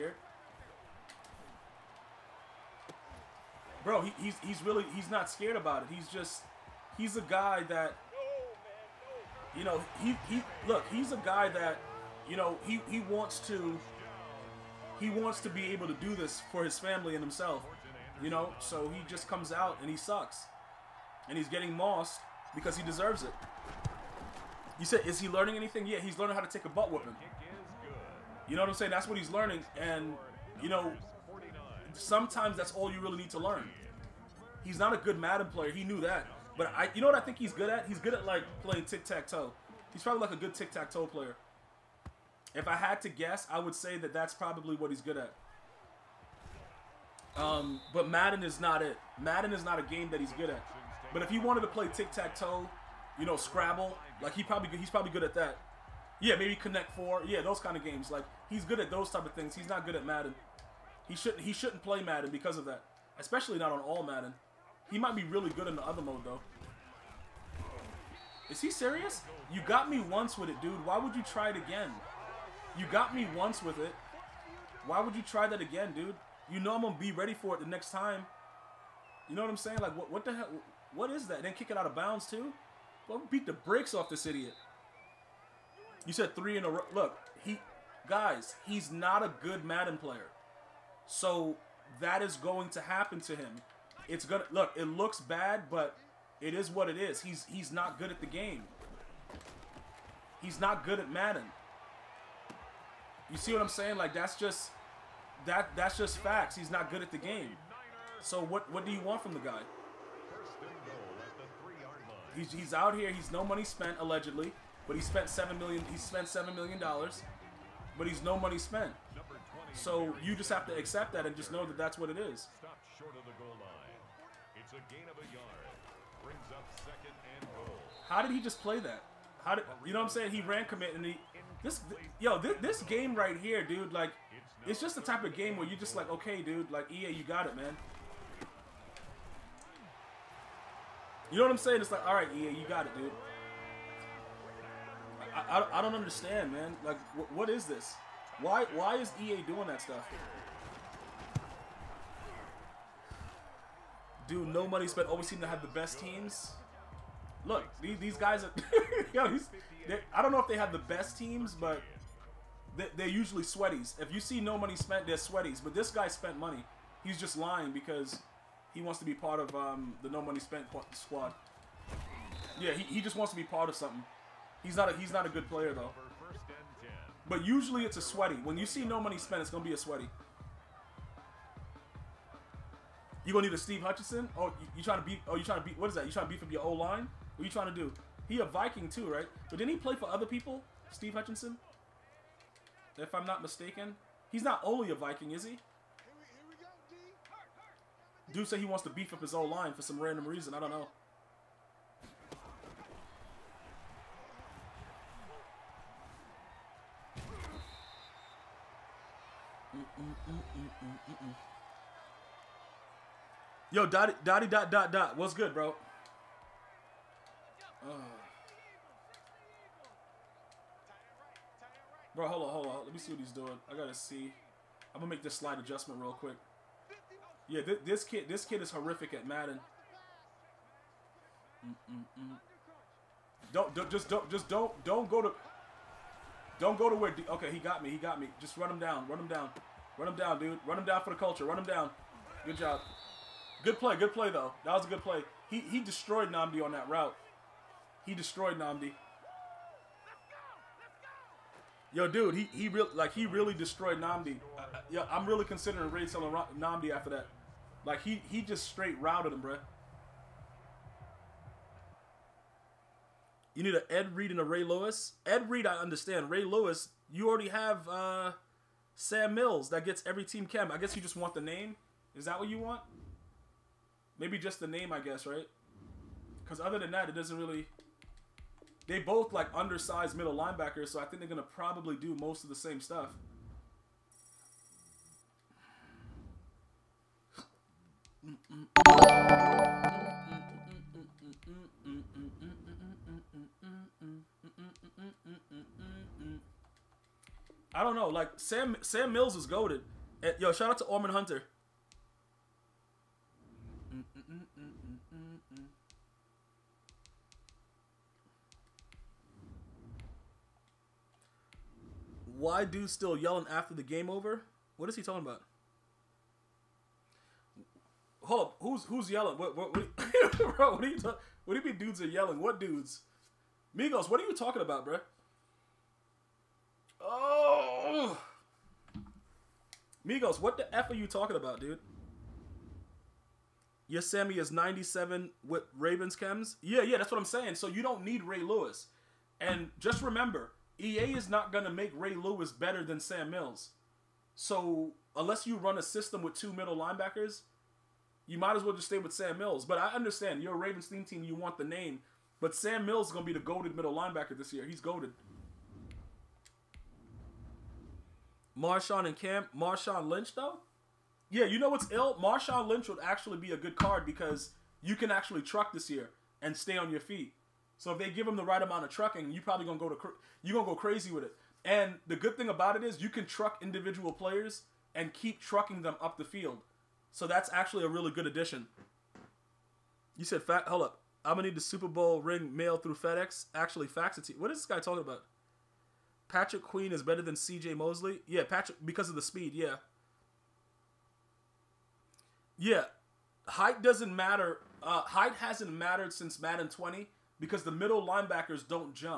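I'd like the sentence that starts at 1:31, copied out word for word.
So that is going to happen to him.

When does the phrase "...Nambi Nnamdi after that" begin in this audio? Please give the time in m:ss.
4:16.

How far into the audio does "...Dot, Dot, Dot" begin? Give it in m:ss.
3:34.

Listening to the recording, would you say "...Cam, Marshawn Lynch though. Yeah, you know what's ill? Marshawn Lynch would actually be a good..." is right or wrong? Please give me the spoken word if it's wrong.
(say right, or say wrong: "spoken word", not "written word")
right.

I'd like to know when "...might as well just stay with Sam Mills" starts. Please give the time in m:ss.
5:48.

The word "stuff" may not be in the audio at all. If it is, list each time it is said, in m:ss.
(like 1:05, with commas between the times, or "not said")
2:29, 4:42.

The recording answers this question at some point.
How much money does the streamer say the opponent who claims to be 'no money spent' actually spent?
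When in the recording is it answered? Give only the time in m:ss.
1:56.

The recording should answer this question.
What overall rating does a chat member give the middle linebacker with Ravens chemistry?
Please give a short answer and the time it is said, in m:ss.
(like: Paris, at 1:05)
97, at 5:34.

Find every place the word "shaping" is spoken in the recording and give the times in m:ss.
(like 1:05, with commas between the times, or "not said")
not said.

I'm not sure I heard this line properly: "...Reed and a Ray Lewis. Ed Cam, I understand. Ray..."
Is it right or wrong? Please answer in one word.
wrong.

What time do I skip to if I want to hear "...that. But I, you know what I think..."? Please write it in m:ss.
0:36.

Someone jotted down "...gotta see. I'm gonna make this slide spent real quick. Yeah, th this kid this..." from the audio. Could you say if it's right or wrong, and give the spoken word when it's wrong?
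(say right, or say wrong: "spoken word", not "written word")
wrong: "adjustment", not "spent".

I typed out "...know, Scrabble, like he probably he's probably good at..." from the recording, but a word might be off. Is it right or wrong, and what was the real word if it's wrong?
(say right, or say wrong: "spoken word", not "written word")
right.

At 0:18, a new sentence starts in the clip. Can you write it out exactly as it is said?
You know, so he just comes out and he sucks and he's getting mossed because he deserves it.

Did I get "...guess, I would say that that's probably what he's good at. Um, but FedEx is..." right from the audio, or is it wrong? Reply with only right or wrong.
wrong.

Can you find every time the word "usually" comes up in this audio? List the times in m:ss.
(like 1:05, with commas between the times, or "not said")
2:43, 2:57.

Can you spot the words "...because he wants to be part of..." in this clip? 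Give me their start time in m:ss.
2:47.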